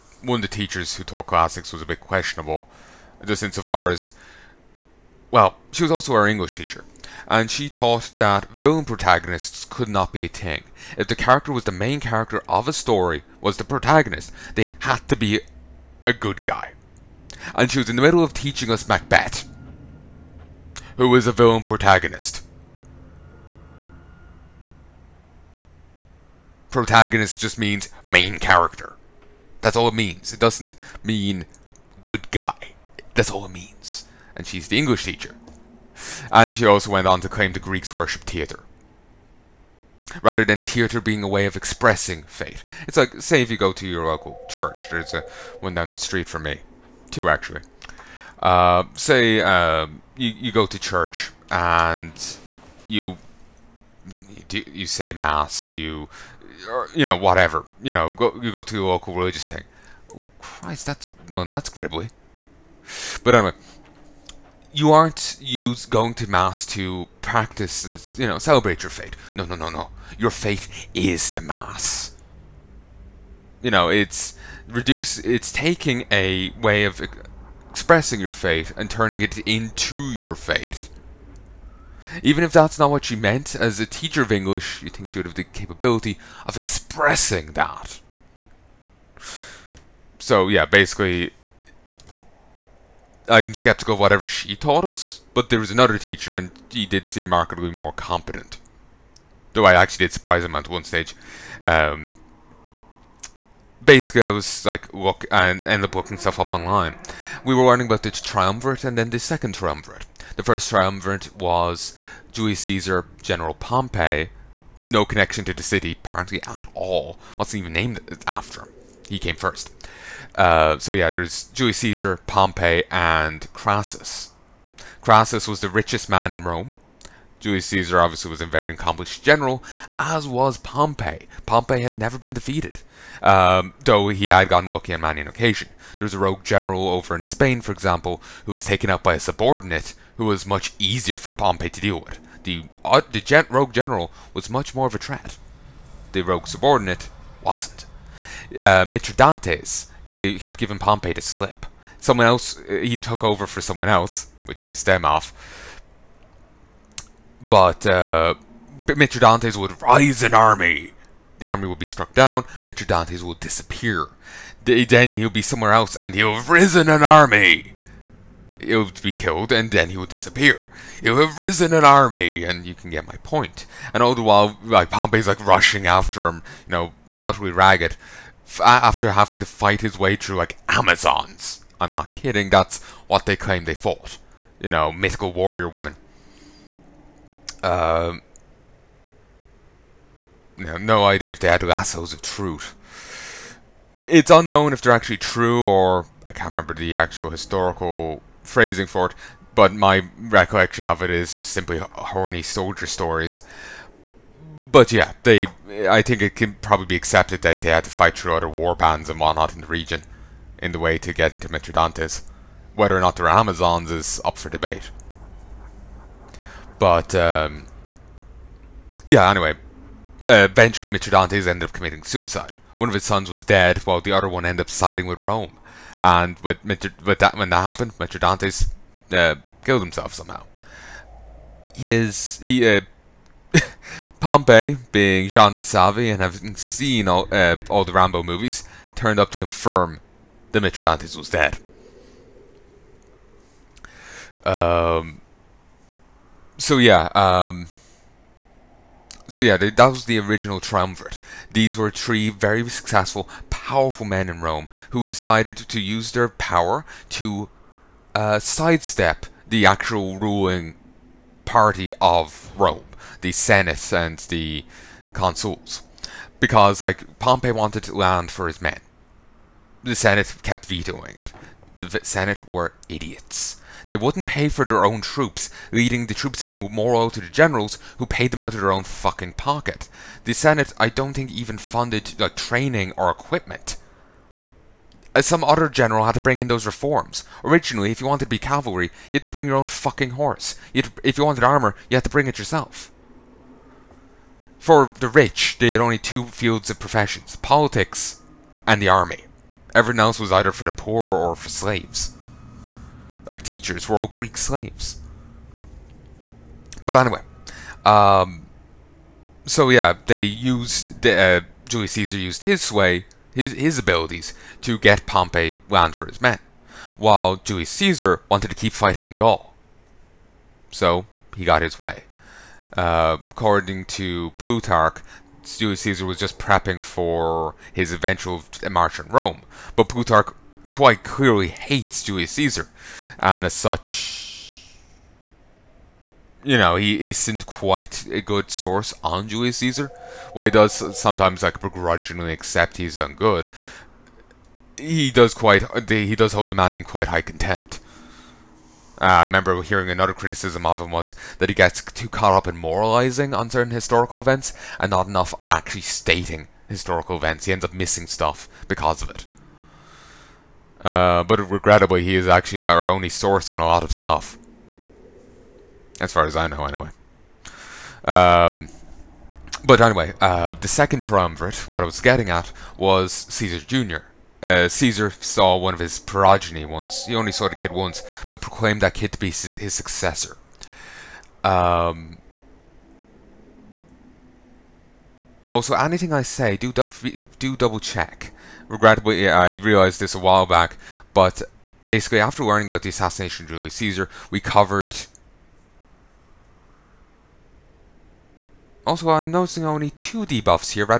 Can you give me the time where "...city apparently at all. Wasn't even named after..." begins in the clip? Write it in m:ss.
1:55.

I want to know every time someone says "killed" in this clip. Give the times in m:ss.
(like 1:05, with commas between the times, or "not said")
2:49, 3:49.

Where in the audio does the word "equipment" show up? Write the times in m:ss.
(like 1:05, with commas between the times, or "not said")
4:43.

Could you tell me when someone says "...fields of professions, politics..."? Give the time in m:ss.
4:56.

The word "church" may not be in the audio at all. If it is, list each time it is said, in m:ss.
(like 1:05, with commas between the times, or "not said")
0:44, 0:50.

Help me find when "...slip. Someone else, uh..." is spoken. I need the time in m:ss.
2:31.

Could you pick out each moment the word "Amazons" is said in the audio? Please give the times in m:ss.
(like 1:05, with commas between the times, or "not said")
3:00, 3:33.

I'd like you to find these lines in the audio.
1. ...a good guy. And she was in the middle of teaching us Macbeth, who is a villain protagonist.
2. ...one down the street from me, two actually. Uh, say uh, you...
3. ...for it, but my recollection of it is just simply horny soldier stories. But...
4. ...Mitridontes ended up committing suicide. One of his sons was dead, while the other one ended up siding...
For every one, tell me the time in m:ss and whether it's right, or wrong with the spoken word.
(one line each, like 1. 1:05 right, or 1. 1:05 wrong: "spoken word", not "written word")
1. 0:16 right
2. 0:45 right
3. 3:18 right
4. 3:40 right.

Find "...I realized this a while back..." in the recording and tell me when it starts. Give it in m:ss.
6:29.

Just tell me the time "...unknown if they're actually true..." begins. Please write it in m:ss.
3:14.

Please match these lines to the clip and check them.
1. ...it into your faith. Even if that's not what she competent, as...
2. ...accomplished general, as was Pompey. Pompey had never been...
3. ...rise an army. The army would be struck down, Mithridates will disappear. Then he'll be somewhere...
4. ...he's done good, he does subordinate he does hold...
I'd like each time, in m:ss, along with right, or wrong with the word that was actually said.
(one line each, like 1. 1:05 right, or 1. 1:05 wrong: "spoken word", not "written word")
1. 1:19 wrong: "meant", not "competent"
2. 2:08 right
3. 2:39 right
4. 5:42 wrong: "quite", not "subordinate".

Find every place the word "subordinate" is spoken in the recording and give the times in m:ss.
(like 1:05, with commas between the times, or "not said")
2:19, 2:26.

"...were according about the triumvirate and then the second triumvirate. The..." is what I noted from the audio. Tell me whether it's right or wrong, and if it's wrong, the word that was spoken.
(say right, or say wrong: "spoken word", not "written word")
wrong: "learning", not "according".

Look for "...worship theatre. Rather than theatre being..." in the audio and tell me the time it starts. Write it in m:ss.
0:37.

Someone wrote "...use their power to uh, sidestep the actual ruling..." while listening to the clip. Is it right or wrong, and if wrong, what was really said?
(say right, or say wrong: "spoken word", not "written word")
right.